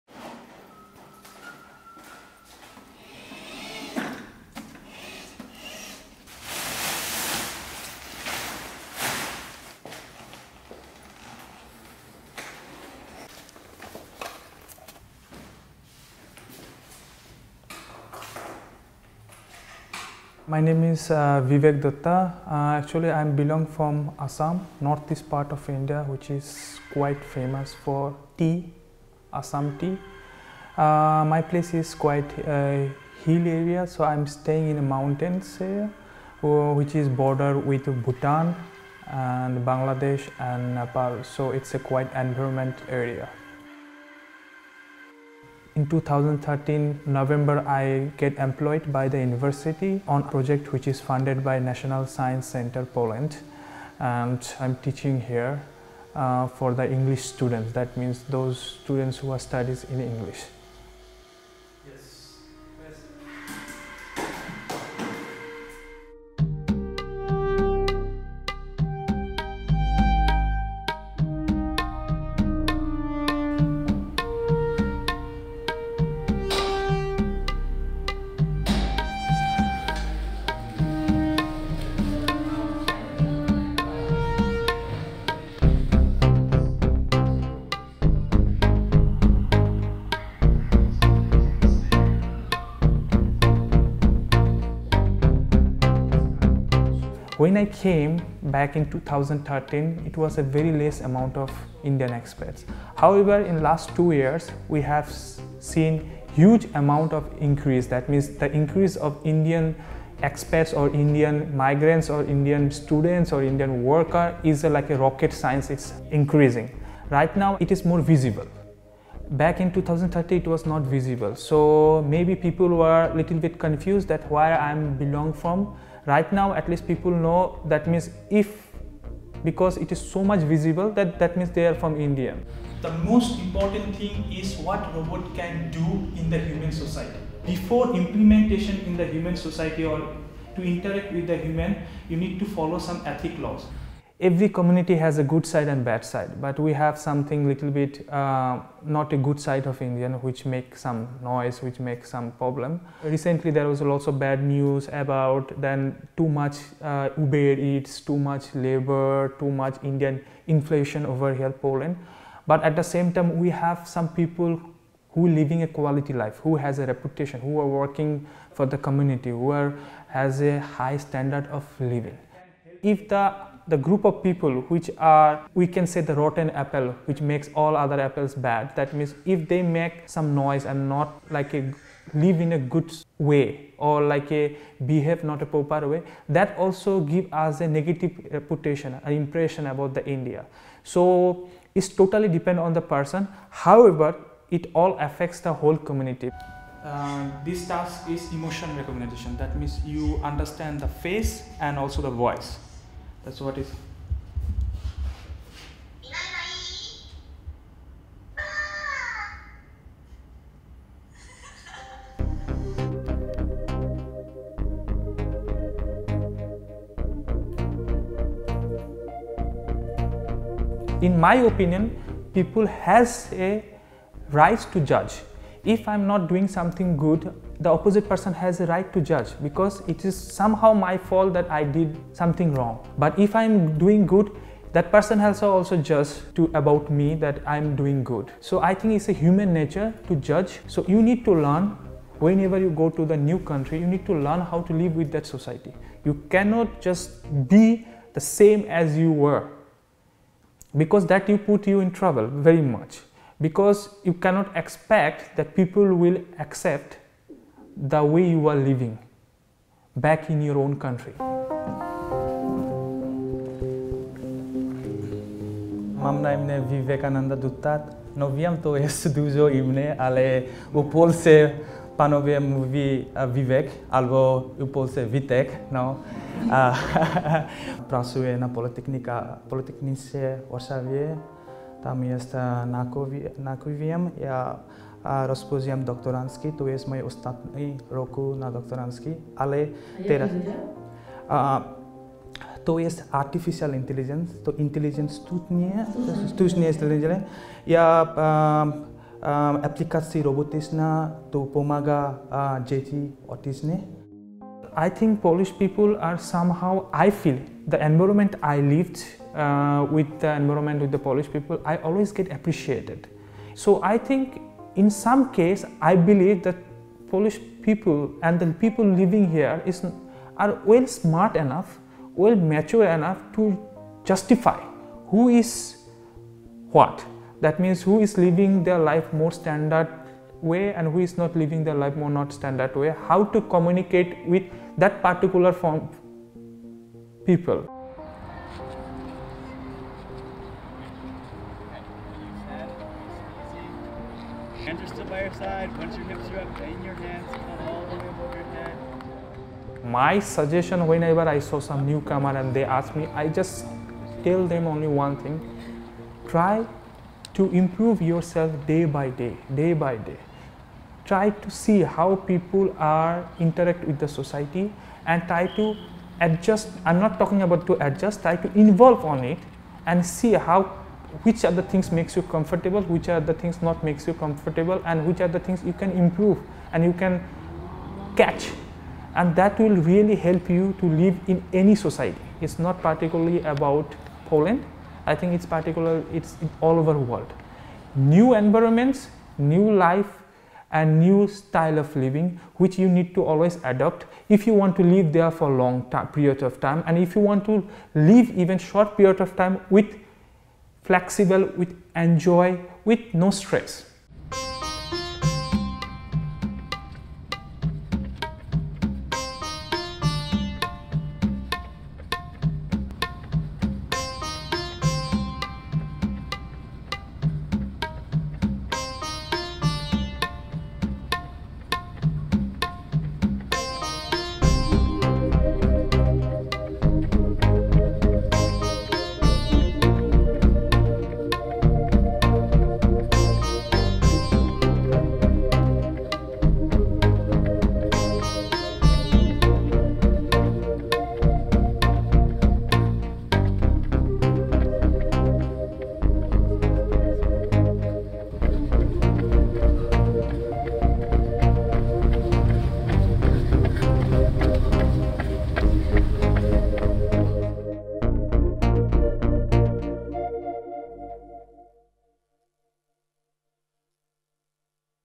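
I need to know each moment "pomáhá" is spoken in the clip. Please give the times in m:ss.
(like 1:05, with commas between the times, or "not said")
5:01.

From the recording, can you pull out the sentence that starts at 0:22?
Uh, actually, I belong from Assam, northeast part of India, which is quite famous for tea, Assam tea.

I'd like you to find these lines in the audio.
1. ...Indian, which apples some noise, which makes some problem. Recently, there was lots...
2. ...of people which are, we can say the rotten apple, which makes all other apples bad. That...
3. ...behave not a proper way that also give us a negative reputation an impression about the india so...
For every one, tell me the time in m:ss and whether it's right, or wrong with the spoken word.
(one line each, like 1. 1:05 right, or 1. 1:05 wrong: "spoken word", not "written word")
1. 2:29 wrong: "makes", not "apples"
2. 2:54 right
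3. 3:04 right.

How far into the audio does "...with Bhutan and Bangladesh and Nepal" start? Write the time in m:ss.
0:37.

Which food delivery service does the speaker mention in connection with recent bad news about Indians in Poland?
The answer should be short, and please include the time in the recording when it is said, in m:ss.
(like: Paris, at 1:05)
Uber Eats, at 2:37.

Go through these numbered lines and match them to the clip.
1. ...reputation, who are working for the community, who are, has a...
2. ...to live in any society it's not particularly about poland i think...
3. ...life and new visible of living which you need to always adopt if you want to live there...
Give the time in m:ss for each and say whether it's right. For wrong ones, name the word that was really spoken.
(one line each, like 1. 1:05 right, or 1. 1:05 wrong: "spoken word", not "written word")
1. 2:46 right
2. 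6:20 right
3. 6:29 wrong: "style", not "visible".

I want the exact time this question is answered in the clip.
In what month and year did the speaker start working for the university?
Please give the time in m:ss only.
0:45.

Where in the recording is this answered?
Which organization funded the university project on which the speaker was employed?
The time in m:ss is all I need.
0:51.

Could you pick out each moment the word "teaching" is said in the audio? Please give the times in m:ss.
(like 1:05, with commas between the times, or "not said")
0:54.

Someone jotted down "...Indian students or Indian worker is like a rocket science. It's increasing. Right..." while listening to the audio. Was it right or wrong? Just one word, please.
right.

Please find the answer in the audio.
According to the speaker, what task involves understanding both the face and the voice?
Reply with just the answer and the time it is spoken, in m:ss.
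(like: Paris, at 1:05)
emotion recognition, at 3:18.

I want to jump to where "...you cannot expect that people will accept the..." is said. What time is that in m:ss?
4:14.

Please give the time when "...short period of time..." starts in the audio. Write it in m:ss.
6:38.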